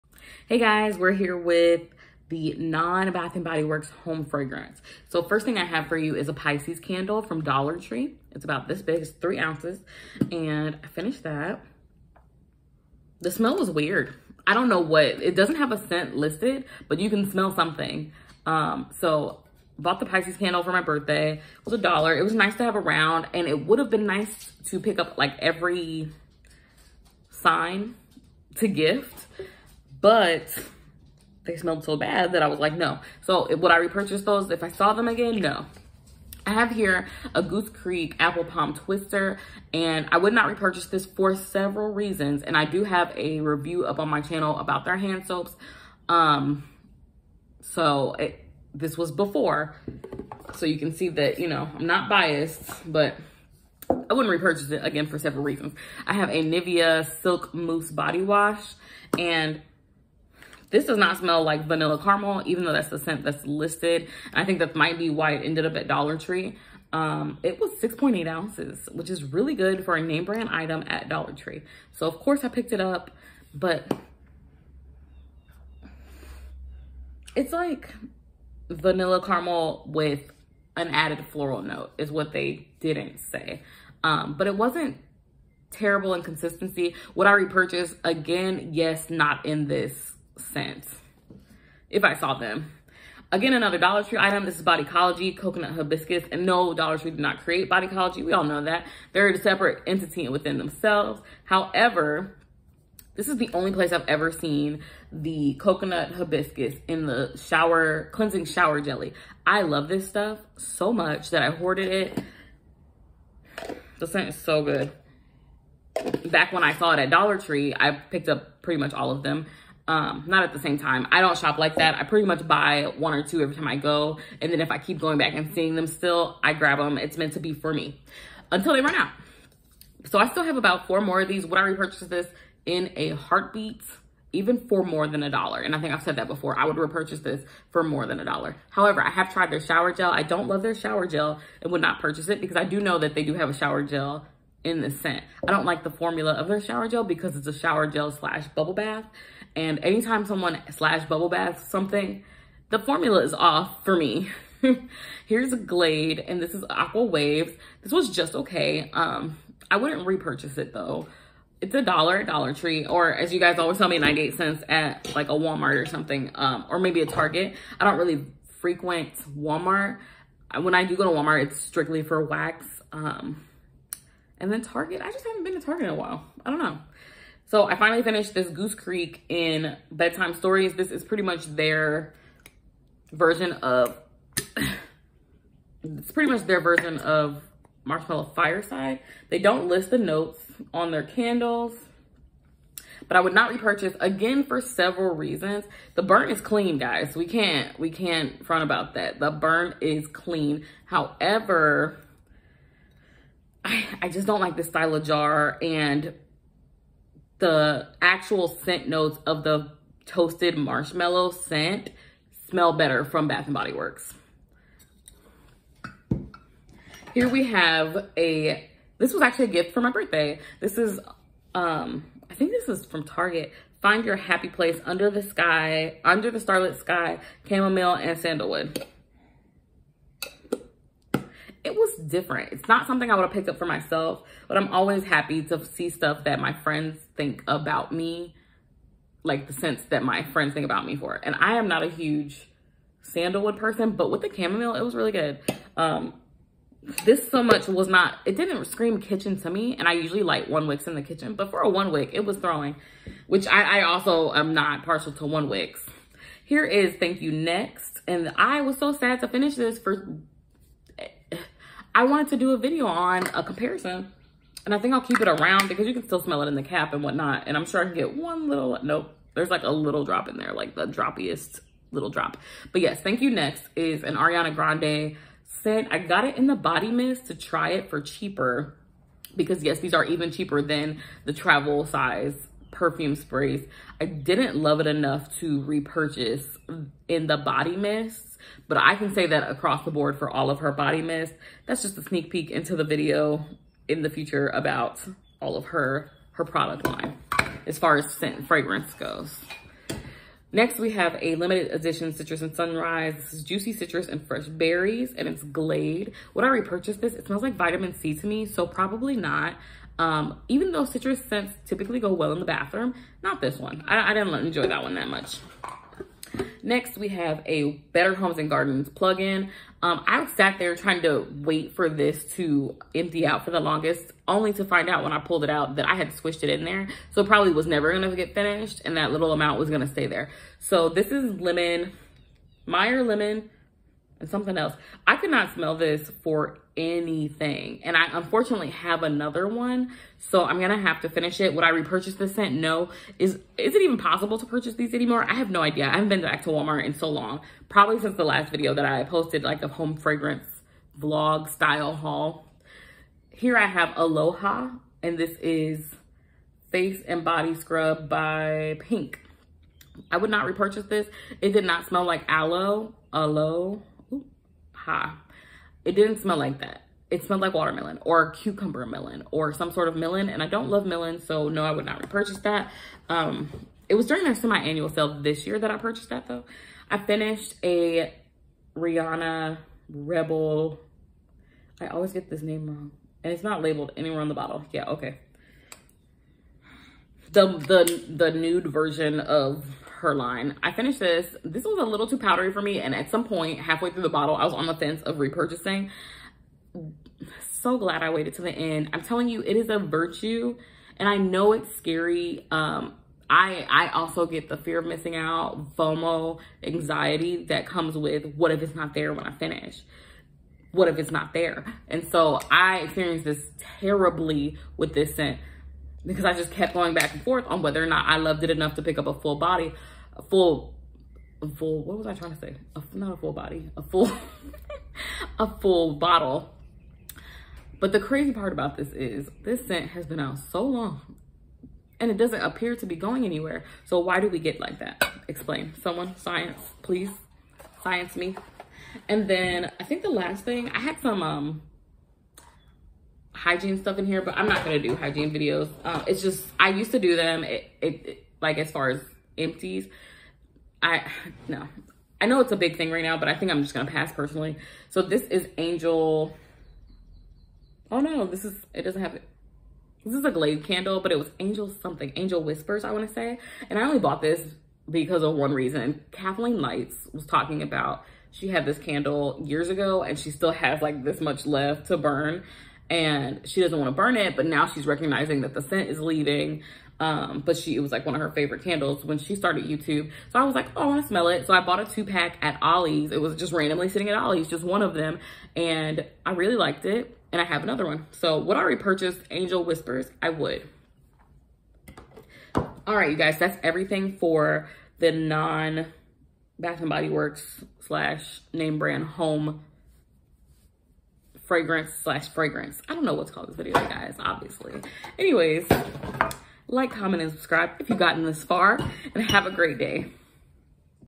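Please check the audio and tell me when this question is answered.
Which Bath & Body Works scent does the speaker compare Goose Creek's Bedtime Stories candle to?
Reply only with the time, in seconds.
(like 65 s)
187 s.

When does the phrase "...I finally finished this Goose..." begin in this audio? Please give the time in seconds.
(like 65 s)
177 s.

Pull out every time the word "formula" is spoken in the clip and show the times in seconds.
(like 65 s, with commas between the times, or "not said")
145 s, 152 s.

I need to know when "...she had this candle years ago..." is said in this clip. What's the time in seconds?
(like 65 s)
468 s.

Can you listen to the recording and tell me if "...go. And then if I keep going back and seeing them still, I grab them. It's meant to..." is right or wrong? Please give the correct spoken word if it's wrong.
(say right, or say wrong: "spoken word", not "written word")
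right.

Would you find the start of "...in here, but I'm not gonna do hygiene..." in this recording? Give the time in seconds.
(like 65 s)
443 s.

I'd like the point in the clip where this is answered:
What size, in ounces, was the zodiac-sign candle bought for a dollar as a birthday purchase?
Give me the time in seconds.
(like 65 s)
9 s.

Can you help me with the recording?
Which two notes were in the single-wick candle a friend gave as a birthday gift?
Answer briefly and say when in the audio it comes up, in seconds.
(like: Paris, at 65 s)
Chamomile and sandalwood, at 227 s.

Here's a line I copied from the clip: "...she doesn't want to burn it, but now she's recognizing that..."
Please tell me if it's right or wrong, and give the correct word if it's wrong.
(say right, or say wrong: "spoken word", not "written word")
right.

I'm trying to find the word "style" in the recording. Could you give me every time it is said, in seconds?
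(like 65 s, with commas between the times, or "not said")
204 s, 351 s.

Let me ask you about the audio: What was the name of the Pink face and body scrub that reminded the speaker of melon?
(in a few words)
Aloe-Ha.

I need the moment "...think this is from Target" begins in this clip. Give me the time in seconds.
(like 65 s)
222 s.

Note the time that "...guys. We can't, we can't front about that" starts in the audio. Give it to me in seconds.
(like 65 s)
196 s.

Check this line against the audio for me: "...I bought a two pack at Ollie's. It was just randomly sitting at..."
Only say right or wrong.
right.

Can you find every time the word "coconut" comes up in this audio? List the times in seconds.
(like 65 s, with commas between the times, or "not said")
95 s, 105 s.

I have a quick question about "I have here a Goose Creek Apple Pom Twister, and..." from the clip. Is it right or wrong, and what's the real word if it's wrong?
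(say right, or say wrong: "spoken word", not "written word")
right.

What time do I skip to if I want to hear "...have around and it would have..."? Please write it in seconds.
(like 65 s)
22 s.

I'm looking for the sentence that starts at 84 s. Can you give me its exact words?
Um, but it wasn't terrible in consistency.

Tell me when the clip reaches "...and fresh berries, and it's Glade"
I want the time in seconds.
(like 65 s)
304 s.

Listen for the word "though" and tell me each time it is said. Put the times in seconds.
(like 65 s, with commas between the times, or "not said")
62 s, 160 s, 310 s, 376 s.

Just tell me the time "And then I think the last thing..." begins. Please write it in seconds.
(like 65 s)
439 s.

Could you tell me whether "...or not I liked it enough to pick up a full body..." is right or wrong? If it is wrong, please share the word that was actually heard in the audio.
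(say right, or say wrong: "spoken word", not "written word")
wrong: "loved", not "liked".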